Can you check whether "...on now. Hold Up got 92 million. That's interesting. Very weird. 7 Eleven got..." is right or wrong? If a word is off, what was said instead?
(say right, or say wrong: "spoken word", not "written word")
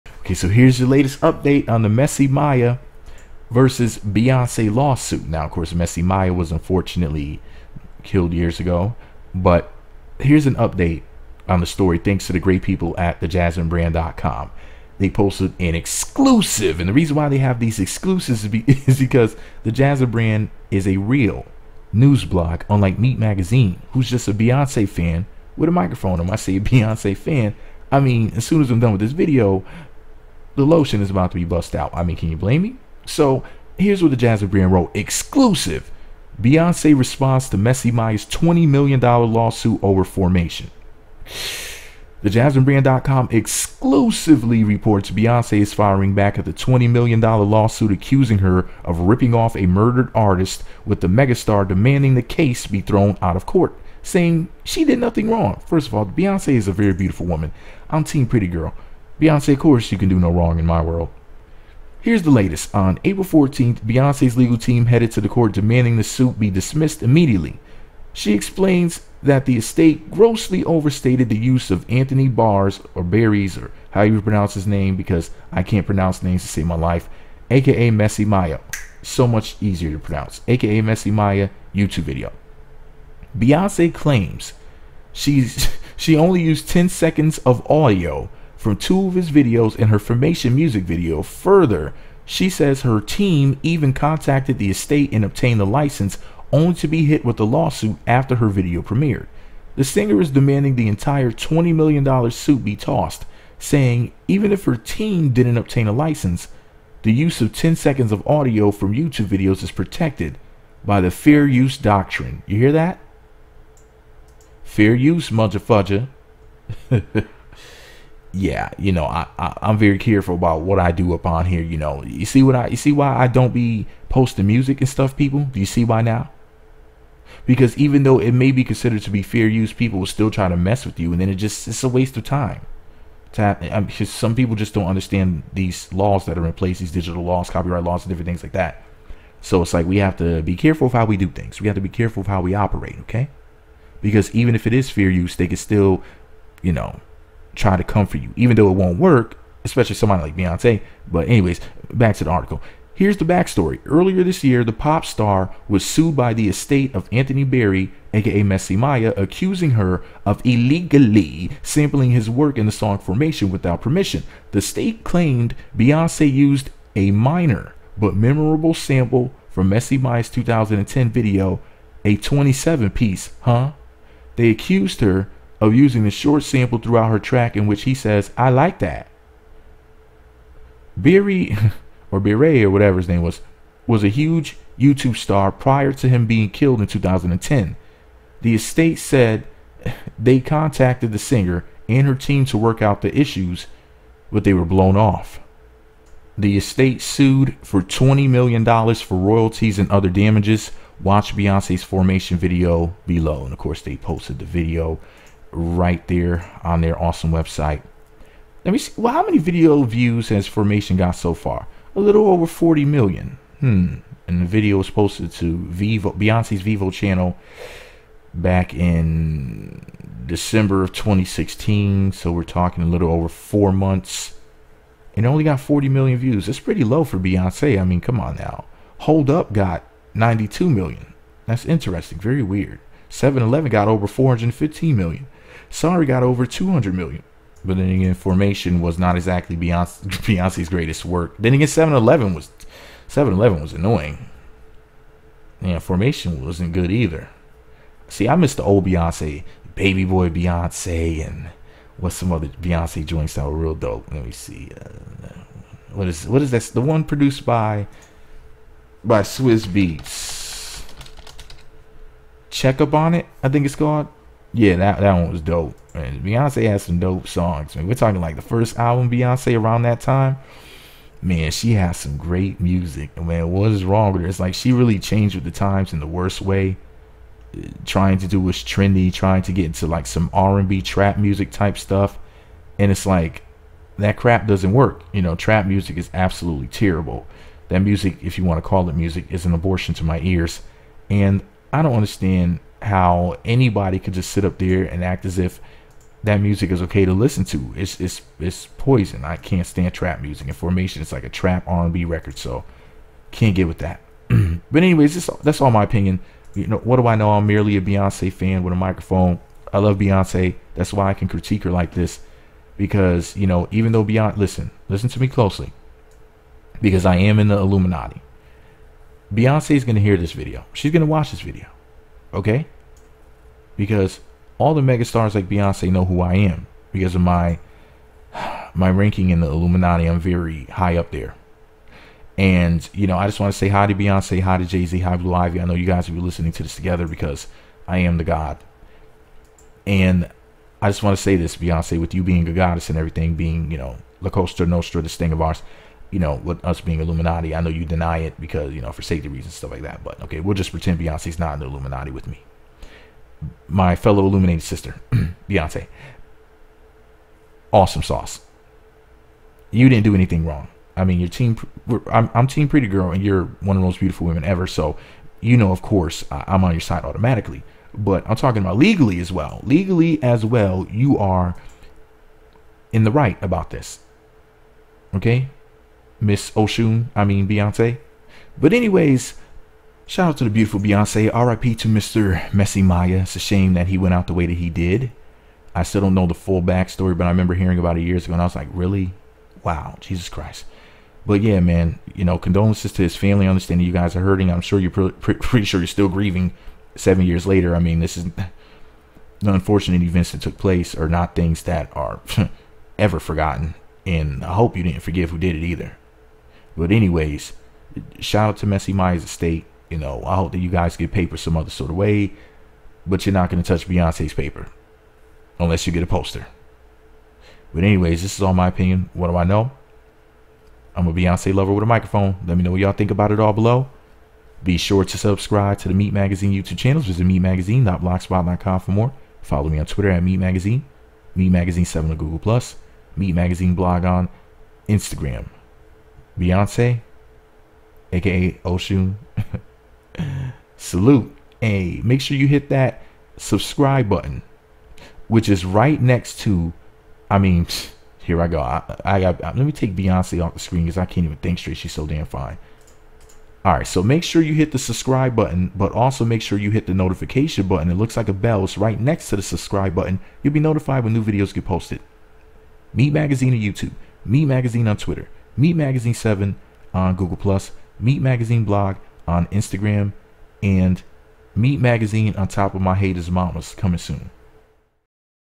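right.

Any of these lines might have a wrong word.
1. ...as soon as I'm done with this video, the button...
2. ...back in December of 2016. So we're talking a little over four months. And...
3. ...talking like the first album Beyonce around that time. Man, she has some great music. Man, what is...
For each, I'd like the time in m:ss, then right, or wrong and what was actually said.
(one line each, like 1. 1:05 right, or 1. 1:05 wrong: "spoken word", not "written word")
1. 0:28 wrong: "lotion", not "button"
2. 3:38 right
3. 4:27 right.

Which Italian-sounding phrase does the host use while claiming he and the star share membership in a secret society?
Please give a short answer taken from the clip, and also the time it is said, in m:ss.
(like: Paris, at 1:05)
La Costa Nostra, at 5:44.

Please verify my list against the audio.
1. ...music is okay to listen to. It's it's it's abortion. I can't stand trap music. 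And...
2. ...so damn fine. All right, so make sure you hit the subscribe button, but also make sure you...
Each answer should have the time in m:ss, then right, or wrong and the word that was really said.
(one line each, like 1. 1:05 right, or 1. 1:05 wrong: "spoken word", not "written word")
1. 4:56 wrong: "poison", not "abortion"
2. 7:31 right.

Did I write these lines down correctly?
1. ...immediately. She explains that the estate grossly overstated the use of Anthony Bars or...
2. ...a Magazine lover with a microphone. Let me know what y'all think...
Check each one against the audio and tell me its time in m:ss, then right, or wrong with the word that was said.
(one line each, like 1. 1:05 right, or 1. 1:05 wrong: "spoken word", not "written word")
1. 1:07 right
2. 7:01 wrong: "Beyonce", not "Magazine".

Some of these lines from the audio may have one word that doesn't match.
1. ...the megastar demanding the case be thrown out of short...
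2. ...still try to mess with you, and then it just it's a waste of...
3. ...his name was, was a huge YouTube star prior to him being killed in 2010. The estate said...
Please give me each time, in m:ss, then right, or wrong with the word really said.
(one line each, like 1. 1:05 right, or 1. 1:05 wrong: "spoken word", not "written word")
1. 0:51 wrong: "court", not "short"
2. 2:10 right
3. 3:02 right.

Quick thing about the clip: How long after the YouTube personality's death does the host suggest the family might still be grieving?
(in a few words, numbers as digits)
7 years.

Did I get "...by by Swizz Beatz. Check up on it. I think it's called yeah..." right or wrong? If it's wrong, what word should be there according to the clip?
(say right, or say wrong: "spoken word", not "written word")
right.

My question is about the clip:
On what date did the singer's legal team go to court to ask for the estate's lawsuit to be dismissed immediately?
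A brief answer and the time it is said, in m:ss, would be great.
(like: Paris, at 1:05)
April 14th, at 1:03.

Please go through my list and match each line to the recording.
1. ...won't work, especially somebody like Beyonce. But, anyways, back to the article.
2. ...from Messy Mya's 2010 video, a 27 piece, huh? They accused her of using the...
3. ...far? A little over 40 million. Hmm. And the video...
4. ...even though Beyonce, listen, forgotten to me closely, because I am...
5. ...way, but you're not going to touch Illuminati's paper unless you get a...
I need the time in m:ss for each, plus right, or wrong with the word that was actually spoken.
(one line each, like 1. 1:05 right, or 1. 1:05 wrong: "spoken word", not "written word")
1. 2:28 right
2. 2:49 right
3. 3:31 right
4. 5:13 wrong: "listen", not "forgotten"
5. 6:51 wrong: "Beyonce", not "Illuminati".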